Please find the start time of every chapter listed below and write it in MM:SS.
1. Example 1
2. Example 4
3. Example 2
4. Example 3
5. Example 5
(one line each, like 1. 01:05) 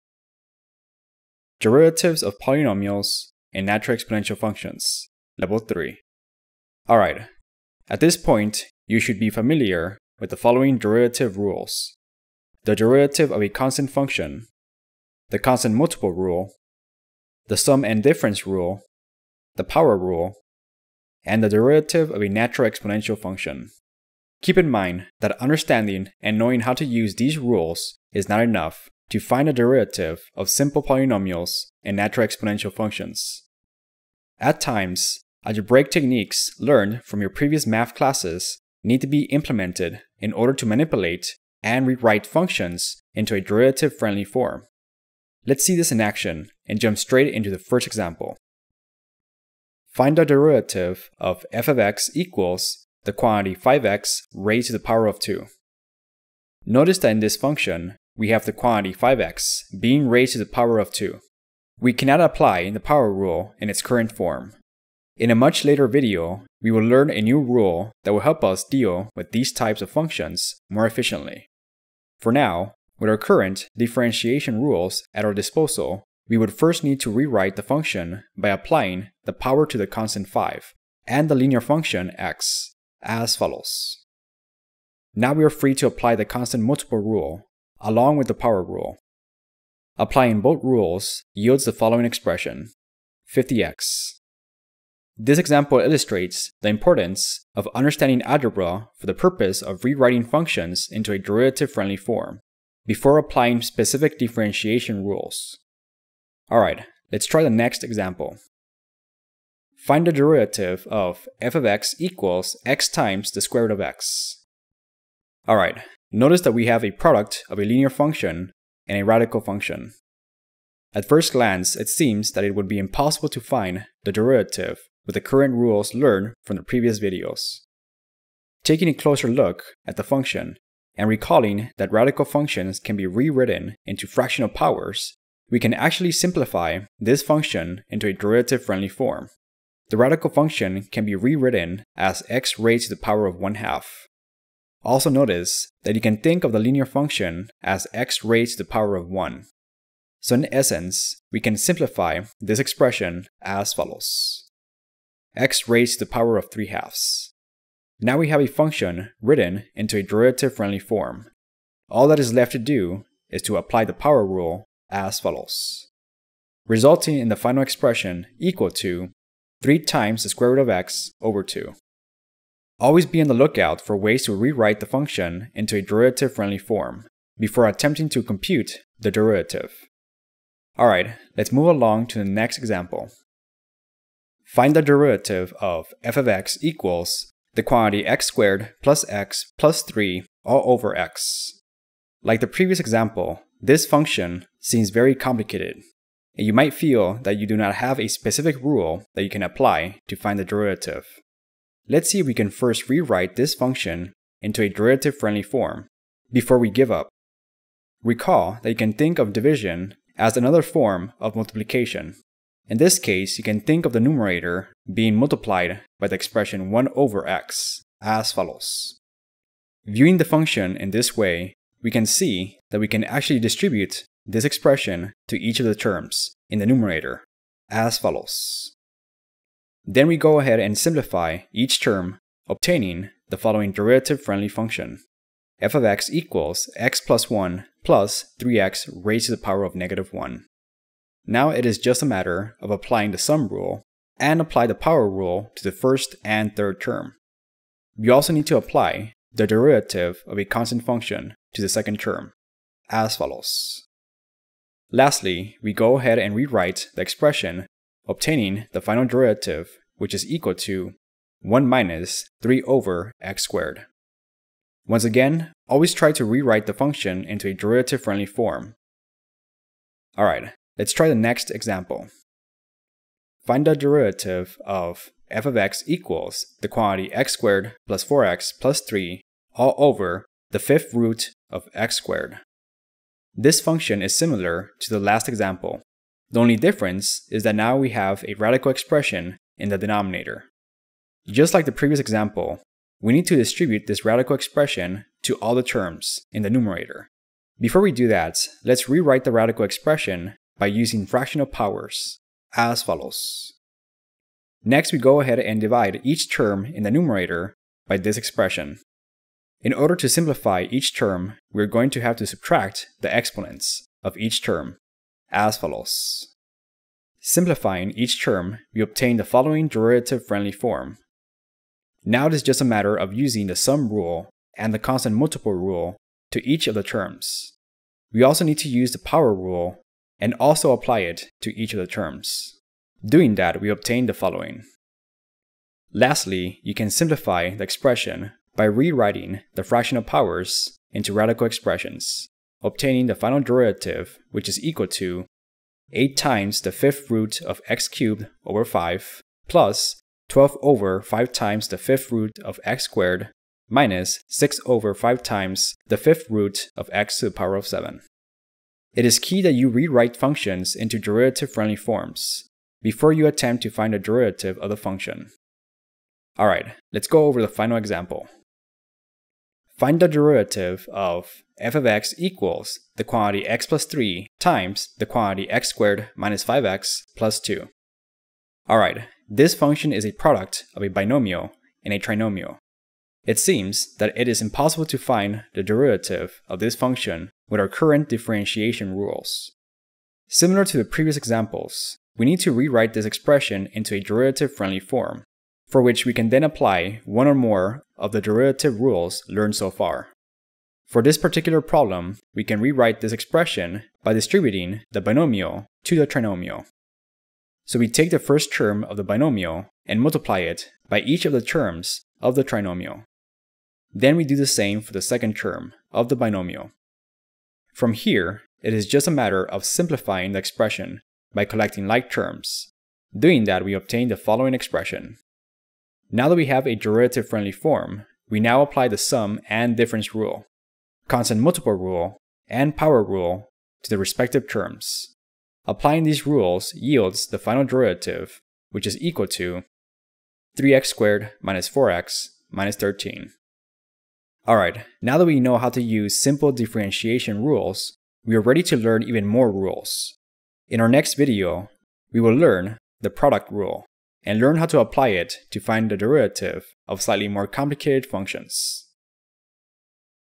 1. 00:48
2. 04:32
3. 01:48
4. 03:02
5. 06:08.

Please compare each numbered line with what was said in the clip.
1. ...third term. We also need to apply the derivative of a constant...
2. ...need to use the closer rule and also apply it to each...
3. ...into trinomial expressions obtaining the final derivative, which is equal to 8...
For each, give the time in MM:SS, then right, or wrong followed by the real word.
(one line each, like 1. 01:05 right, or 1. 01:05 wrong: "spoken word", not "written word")
1. 04:06 right
2. 05:28 wrong: "power", not "closer"
3. 05:40 wrong: "radical", not "trinomial".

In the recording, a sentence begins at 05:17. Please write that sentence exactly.
Simplifying each term, we obtain the following derivative-friendly form.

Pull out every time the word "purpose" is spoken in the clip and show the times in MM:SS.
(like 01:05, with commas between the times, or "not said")
01:39.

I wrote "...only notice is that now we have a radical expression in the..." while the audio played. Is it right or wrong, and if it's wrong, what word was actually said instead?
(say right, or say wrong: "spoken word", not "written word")
wrong: "difference", not "notice".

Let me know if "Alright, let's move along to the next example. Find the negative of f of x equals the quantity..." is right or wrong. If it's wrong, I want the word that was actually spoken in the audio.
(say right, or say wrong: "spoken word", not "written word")
wrong: "derivative", not "negative".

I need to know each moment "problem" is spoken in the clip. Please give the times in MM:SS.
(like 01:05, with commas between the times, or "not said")
06:41.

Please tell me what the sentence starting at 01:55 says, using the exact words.
Alright, Notice that we have a product of a linear function and a radical function.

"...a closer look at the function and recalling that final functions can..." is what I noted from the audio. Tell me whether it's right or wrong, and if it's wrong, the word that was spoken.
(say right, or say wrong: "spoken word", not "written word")
wrong: "radical", not "final".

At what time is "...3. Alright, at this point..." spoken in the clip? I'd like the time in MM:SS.
00:05.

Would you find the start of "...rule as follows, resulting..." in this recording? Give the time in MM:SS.
02:44.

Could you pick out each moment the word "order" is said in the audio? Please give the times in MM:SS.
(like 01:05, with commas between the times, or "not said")
00:40, 05:09.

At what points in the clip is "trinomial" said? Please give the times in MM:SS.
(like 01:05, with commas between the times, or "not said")
06:21, 06:46, 06:52.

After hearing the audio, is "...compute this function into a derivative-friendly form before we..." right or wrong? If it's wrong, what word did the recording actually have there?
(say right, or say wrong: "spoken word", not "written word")
wrong: "rewrite", not "compute".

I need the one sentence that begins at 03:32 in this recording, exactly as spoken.
In this case, you can think of the numerator being multiplied by the expression 1 over x as follows.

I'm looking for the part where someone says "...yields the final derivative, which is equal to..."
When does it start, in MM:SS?
07:16.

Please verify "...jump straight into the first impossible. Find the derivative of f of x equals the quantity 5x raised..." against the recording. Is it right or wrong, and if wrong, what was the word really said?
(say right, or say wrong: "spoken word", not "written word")
wrong: "example", not "impossible".